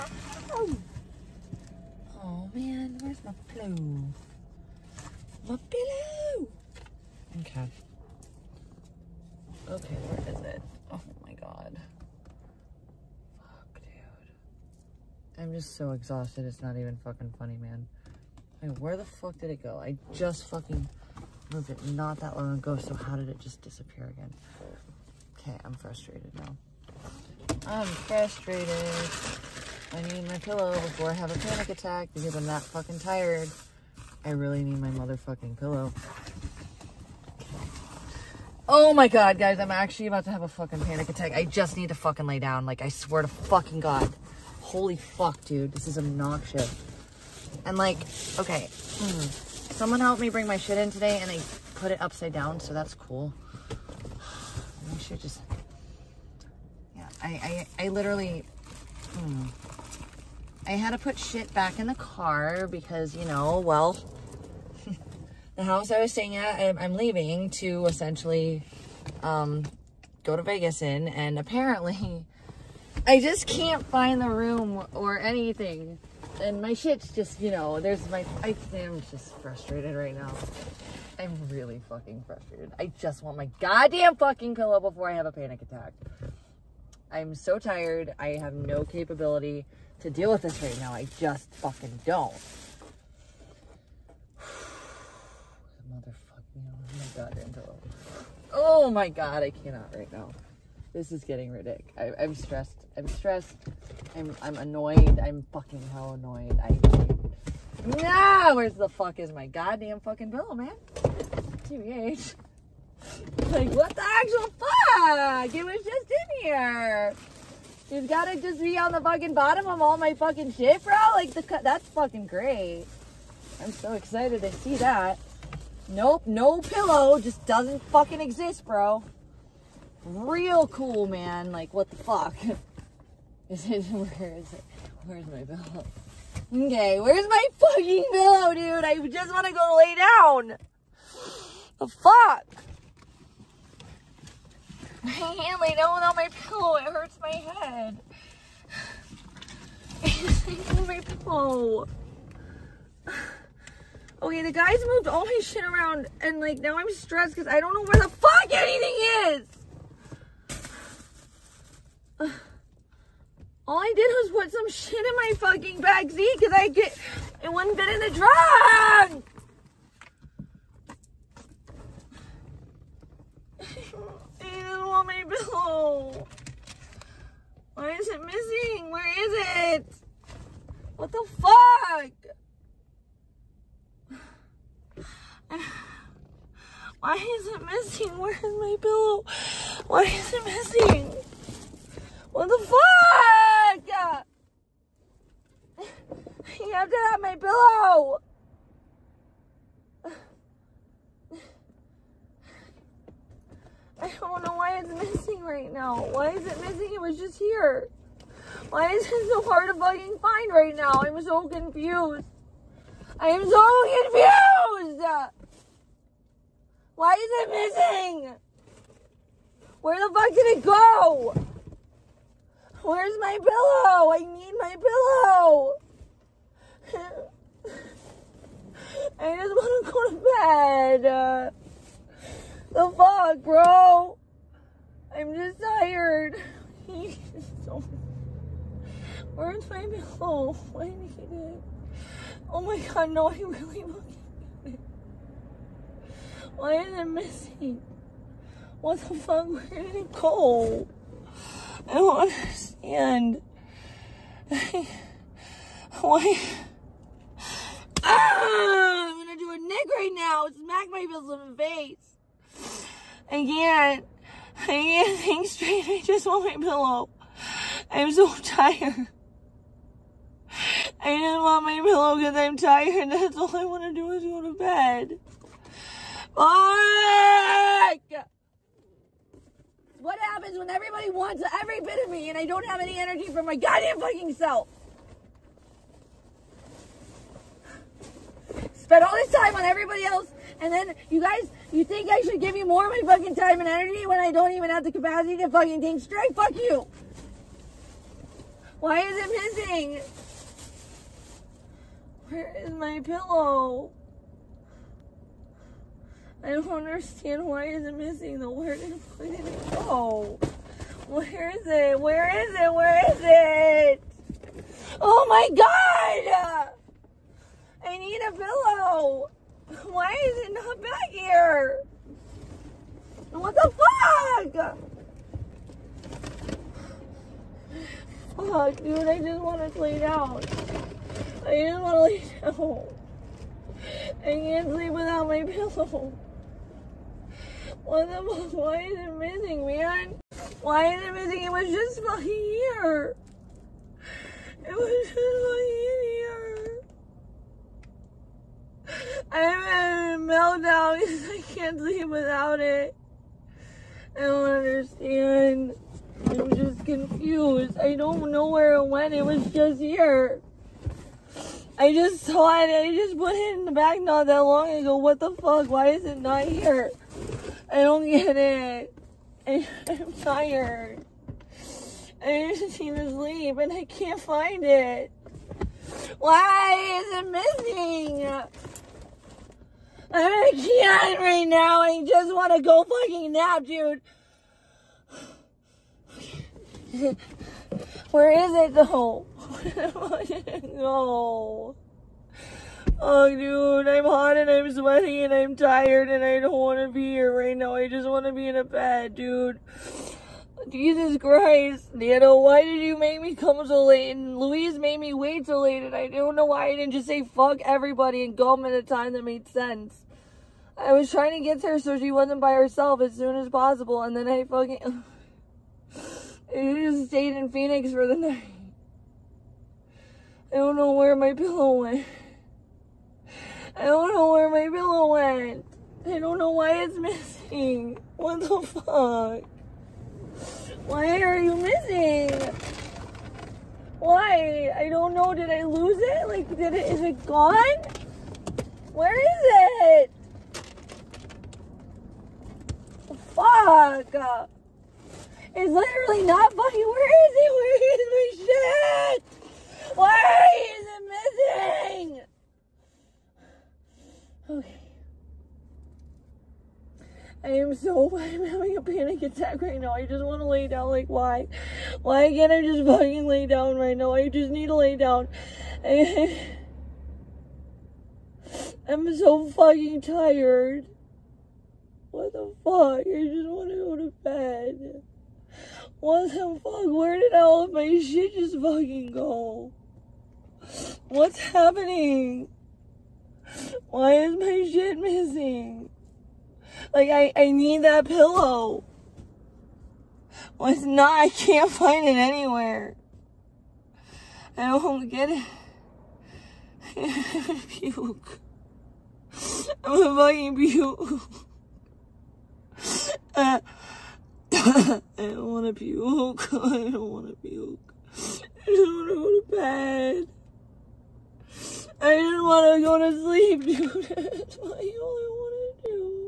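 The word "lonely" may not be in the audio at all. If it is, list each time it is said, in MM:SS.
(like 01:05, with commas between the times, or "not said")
not said.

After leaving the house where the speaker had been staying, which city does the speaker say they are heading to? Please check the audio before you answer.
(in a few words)
Vegas.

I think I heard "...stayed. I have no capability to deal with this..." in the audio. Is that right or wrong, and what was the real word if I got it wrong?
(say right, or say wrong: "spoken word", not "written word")
wrong: "tired", not "stayed".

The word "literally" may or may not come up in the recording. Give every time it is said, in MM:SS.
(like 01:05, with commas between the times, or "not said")
00:57, 07:25.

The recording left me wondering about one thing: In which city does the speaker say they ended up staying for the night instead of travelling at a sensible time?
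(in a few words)
Phoenix.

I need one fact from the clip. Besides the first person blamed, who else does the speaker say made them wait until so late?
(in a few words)
Louise.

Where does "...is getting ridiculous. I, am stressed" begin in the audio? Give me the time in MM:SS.
01:41.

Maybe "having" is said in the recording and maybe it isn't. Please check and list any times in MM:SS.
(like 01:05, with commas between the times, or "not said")
05:49, 07:38.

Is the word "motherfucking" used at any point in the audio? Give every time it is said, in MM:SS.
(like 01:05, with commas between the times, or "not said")
00:34, 01:35.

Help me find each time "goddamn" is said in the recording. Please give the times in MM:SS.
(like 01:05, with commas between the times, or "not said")
01:23, 01:49, 04:43.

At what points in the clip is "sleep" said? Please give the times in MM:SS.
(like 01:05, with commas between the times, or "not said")
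05:34, 05:51, 06:13, 08:33.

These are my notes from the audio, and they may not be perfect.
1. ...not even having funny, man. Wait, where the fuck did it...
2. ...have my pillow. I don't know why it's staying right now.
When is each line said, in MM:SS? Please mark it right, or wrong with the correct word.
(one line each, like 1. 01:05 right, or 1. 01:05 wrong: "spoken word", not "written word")
1. 00:16 wrong: "fucking", not "having"
2. 03:17 wrong: "missing", not "staying".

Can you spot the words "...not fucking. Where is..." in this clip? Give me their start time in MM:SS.
07:26.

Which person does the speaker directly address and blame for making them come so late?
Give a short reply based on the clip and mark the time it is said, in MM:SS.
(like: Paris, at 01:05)
Nano, at 06:41.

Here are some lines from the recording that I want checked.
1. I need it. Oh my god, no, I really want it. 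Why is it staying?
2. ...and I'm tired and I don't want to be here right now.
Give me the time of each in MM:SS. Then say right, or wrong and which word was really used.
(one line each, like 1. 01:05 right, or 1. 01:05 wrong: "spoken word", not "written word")
1. 04:00 wrong: "missing", not "staying"
2. 06:35 right.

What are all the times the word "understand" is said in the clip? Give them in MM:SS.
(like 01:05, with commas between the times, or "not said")
04:12, 05:06, 05:54.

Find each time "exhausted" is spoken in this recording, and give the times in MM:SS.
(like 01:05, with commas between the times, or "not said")
00:15.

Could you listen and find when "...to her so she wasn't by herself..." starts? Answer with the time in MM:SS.
06:51.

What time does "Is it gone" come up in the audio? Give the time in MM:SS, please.
07:16.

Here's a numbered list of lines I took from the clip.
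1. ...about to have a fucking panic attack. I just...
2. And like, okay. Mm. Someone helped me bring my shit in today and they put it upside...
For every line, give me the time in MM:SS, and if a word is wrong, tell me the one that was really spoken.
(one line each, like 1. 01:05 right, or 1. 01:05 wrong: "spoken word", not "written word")
1. 00:40 right
2. 00:47 right.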